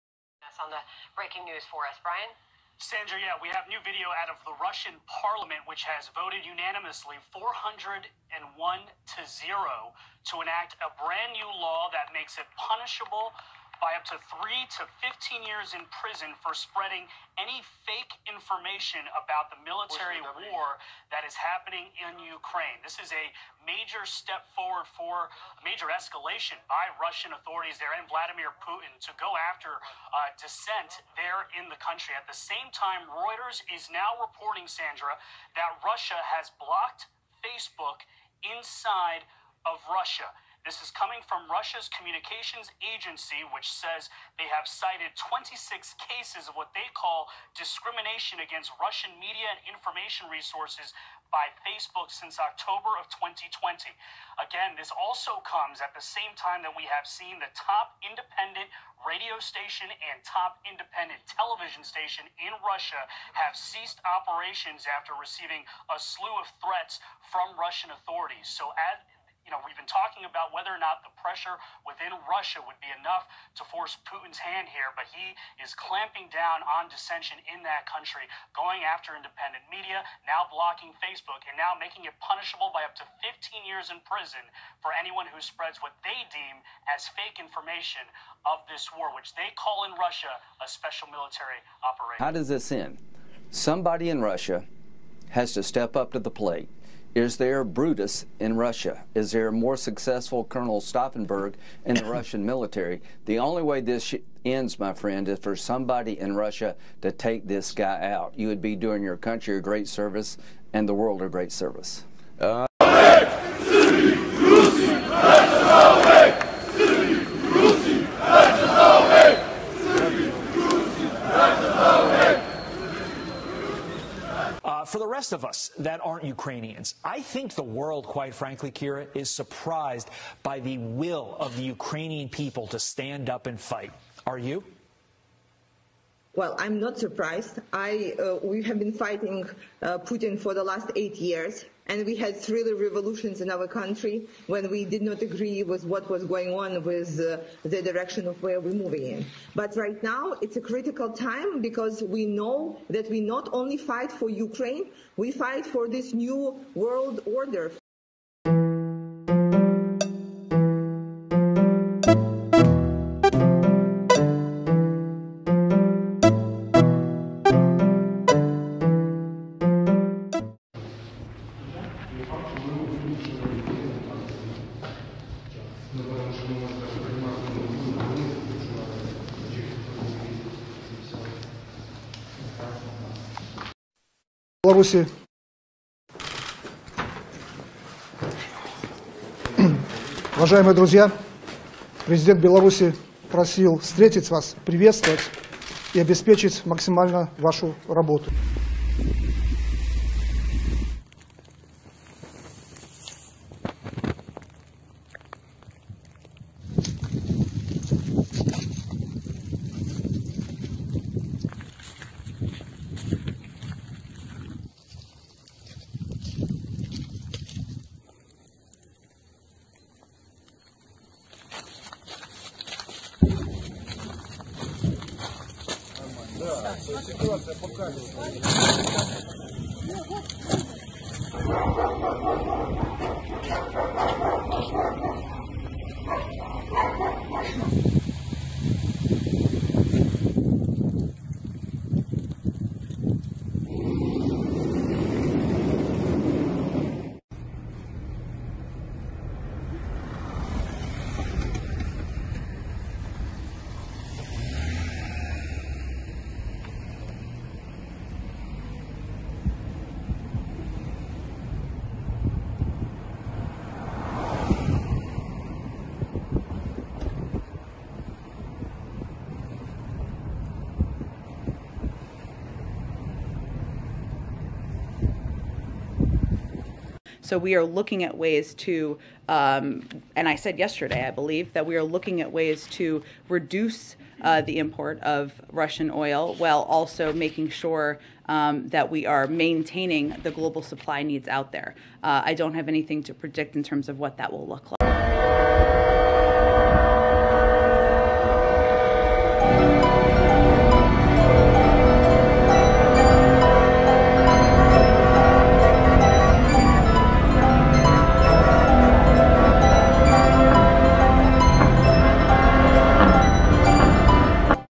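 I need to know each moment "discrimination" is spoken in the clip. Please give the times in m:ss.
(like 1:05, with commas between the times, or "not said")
0:47.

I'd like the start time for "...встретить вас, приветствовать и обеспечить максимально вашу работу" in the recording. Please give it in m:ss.
3:13.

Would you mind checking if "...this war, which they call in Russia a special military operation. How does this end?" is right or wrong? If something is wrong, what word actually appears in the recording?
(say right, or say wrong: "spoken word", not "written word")
right.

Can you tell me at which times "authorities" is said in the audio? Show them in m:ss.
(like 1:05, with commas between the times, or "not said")
0:27, 1:07.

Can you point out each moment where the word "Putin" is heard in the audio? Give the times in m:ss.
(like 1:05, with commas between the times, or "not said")
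0:28, 1:14, 2:20.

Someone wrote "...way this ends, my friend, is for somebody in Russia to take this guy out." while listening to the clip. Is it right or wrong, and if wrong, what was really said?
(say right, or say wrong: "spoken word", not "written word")
right.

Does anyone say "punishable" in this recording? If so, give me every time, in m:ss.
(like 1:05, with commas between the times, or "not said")
0:12, 1:22.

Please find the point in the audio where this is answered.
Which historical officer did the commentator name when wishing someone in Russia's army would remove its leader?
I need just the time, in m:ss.
1:40.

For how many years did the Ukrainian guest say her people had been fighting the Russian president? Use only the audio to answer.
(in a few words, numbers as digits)
8 years.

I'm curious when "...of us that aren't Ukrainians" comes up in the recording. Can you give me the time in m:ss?
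2:05.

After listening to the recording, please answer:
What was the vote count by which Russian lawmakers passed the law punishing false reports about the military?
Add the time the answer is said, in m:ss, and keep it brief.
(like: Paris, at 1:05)
401 to 0, at 0:07.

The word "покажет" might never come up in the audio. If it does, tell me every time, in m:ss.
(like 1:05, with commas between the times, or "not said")
3:47.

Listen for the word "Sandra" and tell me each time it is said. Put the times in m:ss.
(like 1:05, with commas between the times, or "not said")
0:02, 0:34.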